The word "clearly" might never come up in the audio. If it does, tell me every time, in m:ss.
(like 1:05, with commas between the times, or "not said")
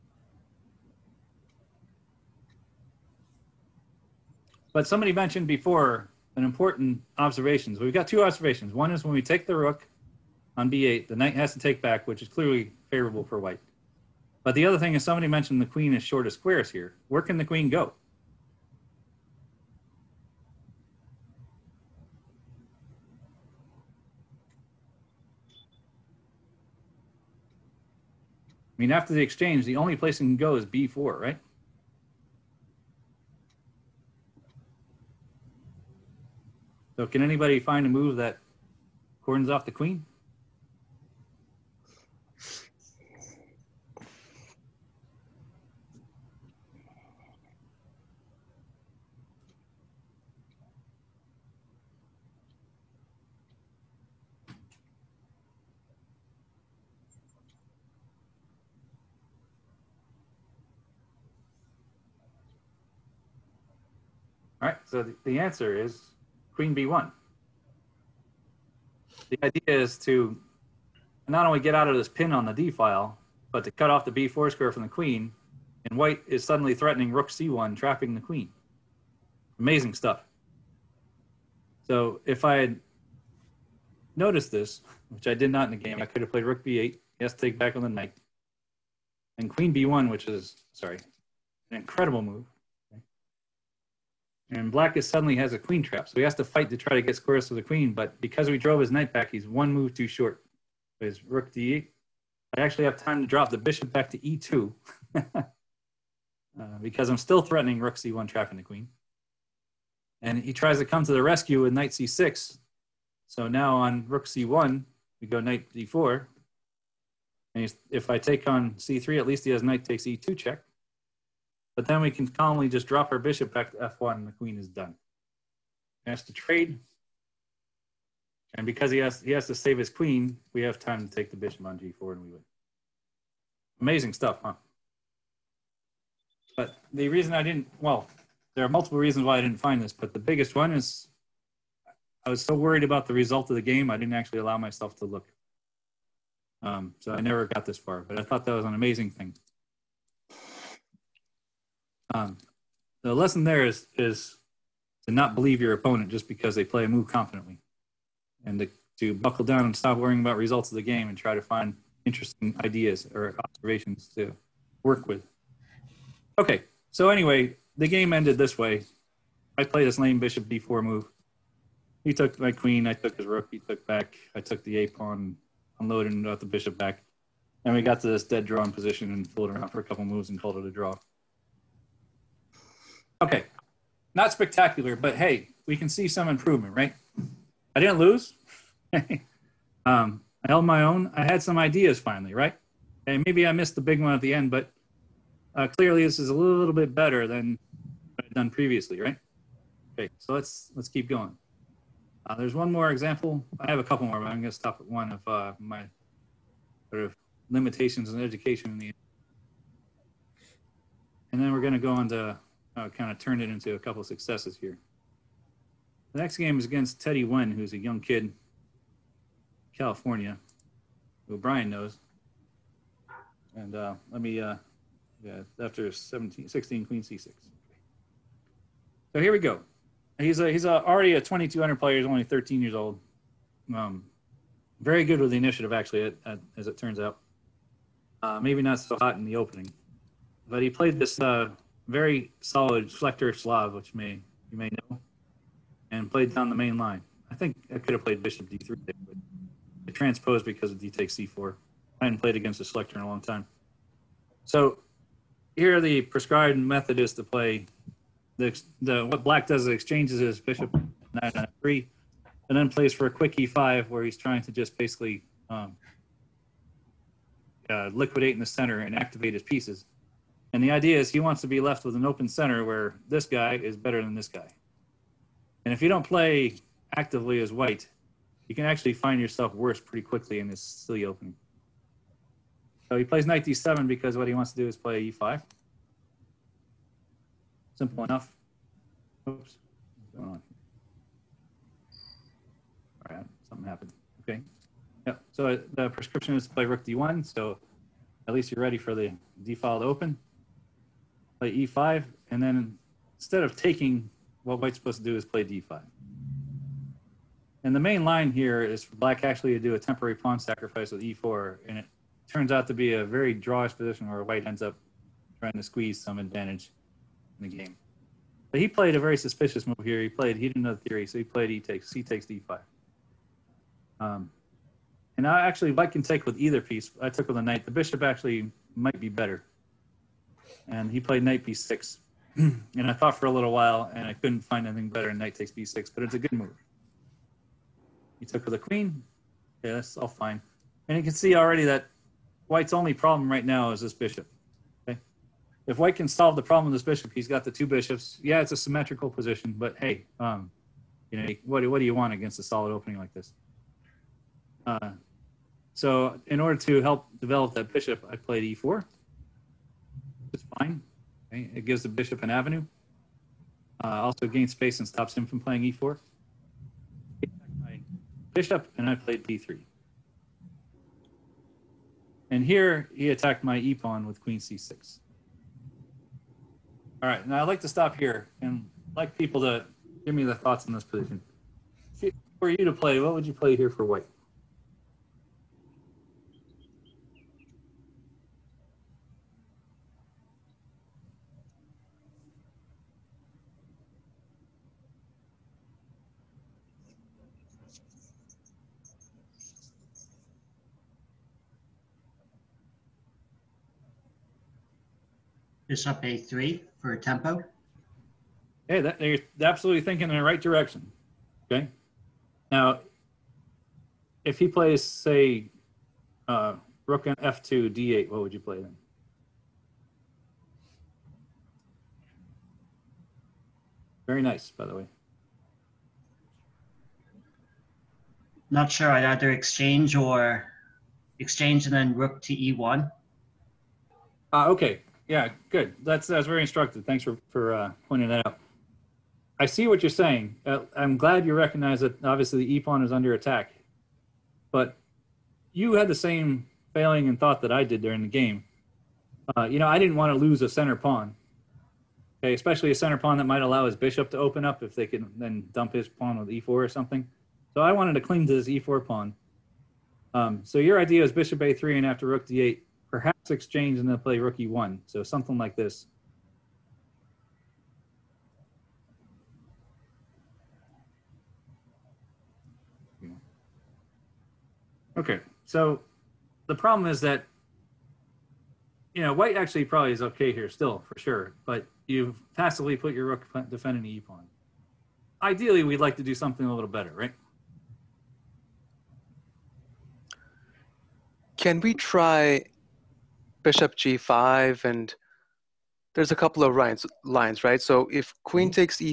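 0:12, 3:15.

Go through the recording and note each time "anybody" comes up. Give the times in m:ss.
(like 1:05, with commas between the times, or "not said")
0:37.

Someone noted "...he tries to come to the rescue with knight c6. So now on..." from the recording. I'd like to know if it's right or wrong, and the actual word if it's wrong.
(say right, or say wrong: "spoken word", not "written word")
right.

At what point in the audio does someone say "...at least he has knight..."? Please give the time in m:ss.
1:59.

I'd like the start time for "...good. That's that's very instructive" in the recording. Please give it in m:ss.
7:15.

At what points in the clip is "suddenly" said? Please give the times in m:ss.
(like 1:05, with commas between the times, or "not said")
1:16, 1:35.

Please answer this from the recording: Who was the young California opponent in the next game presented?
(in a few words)
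Teddy Wen.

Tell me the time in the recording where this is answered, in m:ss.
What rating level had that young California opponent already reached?
3:51.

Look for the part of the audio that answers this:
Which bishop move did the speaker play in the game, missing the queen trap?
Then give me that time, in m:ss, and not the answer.
2:50.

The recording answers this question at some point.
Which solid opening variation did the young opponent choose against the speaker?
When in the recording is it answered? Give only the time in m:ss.
4:02.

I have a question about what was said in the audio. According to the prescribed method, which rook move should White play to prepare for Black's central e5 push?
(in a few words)
Rook d1.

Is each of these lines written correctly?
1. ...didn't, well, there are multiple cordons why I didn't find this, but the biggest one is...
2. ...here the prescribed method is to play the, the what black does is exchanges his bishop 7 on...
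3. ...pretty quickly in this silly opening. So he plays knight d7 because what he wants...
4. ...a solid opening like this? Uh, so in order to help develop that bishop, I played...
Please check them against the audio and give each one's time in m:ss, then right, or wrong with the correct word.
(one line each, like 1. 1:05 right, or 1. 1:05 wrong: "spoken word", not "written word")
1. 2:17 wrong: "reasons", not "cordons"
2. 4:15 wrong: "9", not "7"
3. 4:39 right
4. 5:52 right.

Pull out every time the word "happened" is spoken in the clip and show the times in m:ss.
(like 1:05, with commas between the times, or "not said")
4:53.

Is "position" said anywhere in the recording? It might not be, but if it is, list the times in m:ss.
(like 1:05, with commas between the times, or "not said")
2:58, 5:13, 5:49, 6:20.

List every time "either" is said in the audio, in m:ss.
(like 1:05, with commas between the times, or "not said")
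5:26, 7:09.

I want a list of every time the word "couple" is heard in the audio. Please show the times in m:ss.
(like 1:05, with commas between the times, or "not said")
2:59, 3:23, 3:33, 8:16.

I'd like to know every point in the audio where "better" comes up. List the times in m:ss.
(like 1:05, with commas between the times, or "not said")
3:16, 4:33, 5:29, 5:34, 8:06.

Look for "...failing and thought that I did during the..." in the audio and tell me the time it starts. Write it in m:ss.
7:26.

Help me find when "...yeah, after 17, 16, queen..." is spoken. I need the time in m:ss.
3:45.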